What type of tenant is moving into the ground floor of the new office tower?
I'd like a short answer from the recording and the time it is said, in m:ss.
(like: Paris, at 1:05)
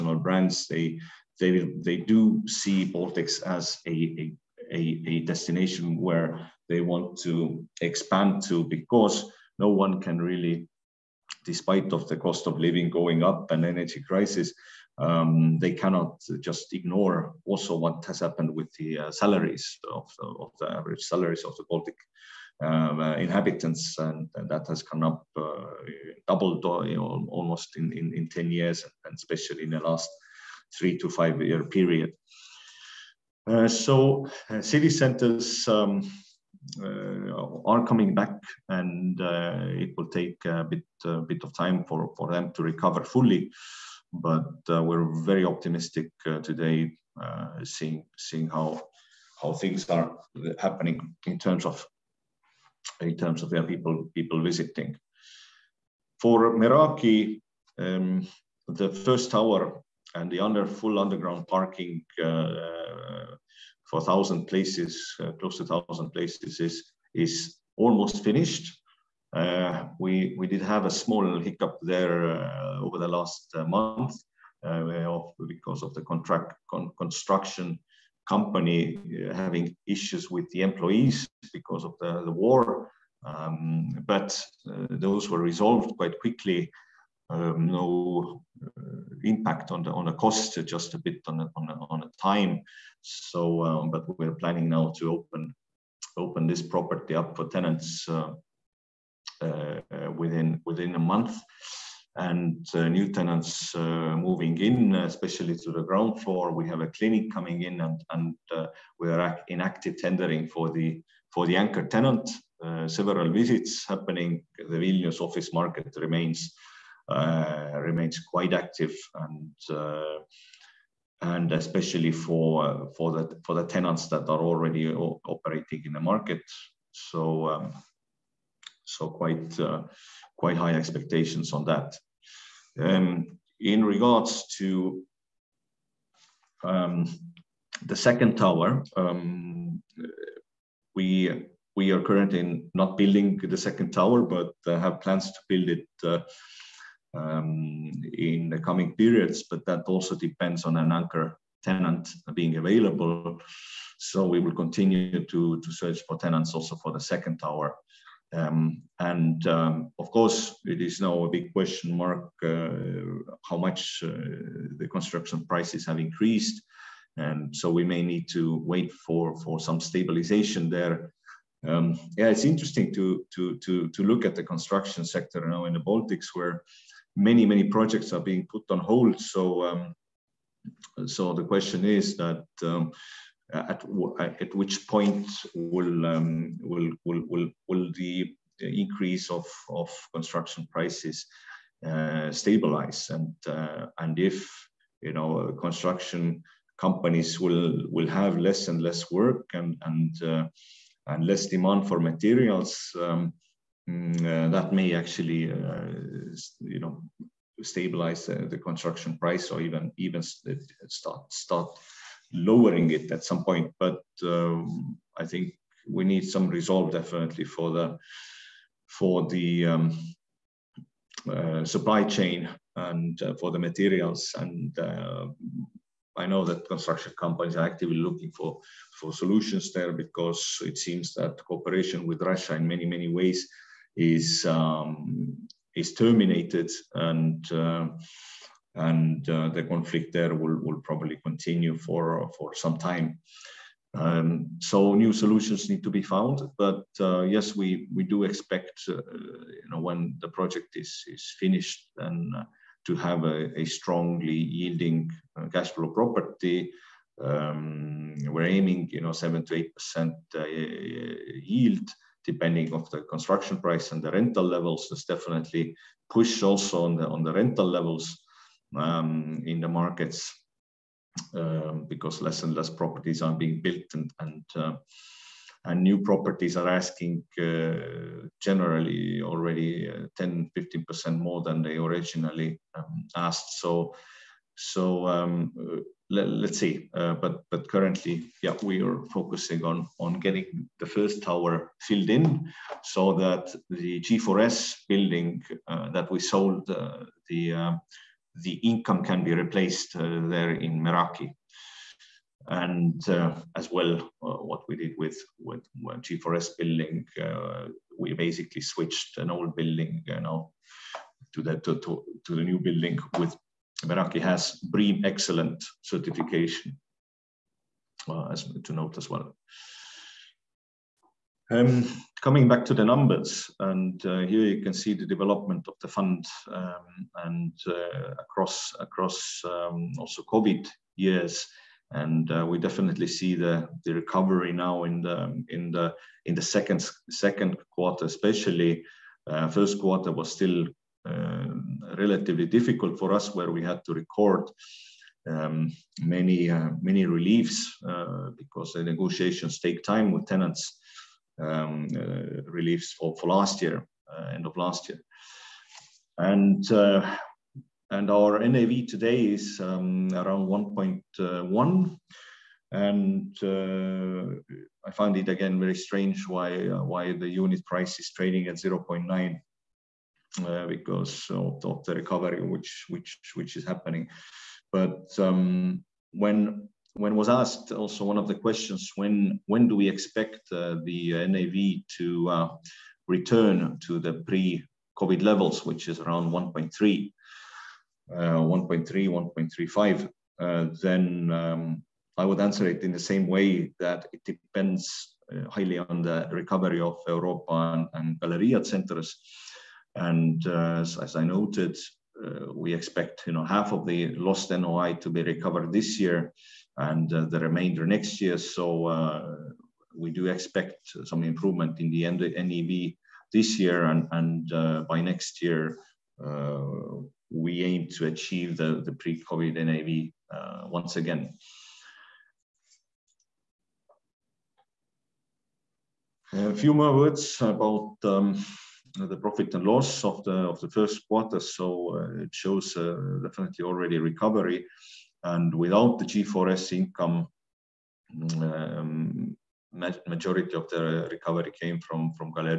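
A clinic, at 1:46.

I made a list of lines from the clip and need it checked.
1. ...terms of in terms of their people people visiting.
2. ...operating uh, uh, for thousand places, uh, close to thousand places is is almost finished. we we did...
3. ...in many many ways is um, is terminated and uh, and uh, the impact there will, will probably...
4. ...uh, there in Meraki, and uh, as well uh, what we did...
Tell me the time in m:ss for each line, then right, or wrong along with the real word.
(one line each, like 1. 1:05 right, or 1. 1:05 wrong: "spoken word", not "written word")
1. 0:51 right
2. 1:01 wrong: "parking", not "operating"
3. 3:52 wrong: "conflict", not "impact"
4. 4:59 right.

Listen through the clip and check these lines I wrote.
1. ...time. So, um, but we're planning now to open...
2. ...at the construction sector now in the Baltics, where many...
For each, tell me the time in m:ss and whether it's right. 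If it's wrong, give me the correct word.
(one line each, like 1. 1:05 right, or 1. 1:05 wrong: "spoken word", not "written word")
1. 1:32 right
2. 2:54 right.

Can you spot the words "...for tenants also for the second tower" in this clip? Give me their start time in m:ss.
2:36.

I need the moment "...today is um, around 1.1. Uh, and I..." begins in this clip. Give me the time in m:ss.
5:58.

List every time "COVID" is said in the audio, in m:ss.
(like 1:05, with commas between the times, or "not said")
5:30, 6:24, 6:58.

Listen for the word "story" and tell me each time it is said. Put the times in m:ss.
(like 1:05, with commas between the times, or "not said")
not said.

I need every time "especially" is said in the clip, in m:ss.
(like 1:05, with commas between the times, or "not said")
0:29, 1:44, 2:01, 5:38.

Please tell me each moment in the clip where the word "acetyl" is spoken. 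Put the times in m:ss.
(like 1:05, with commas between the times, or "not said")
not said.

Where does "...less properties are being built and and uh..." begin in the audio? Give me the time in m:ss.
4:32.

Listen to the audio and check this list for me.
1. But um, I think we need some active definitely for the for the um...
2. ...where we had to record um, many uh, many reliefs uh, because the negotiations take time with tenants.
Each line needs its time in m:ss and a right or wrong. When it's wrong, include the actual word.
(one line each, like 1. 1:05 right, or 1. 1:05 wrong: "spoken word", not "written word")
1. 3:33 wrong: "resolve", not "active"
2. 5:43 right.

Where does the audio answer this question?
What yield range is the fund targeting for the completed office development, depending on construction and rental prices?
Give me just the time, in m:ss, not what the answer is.
4:19.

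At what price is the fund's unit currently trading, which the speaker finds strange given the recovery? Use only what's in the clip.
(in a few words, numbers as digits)
0.9.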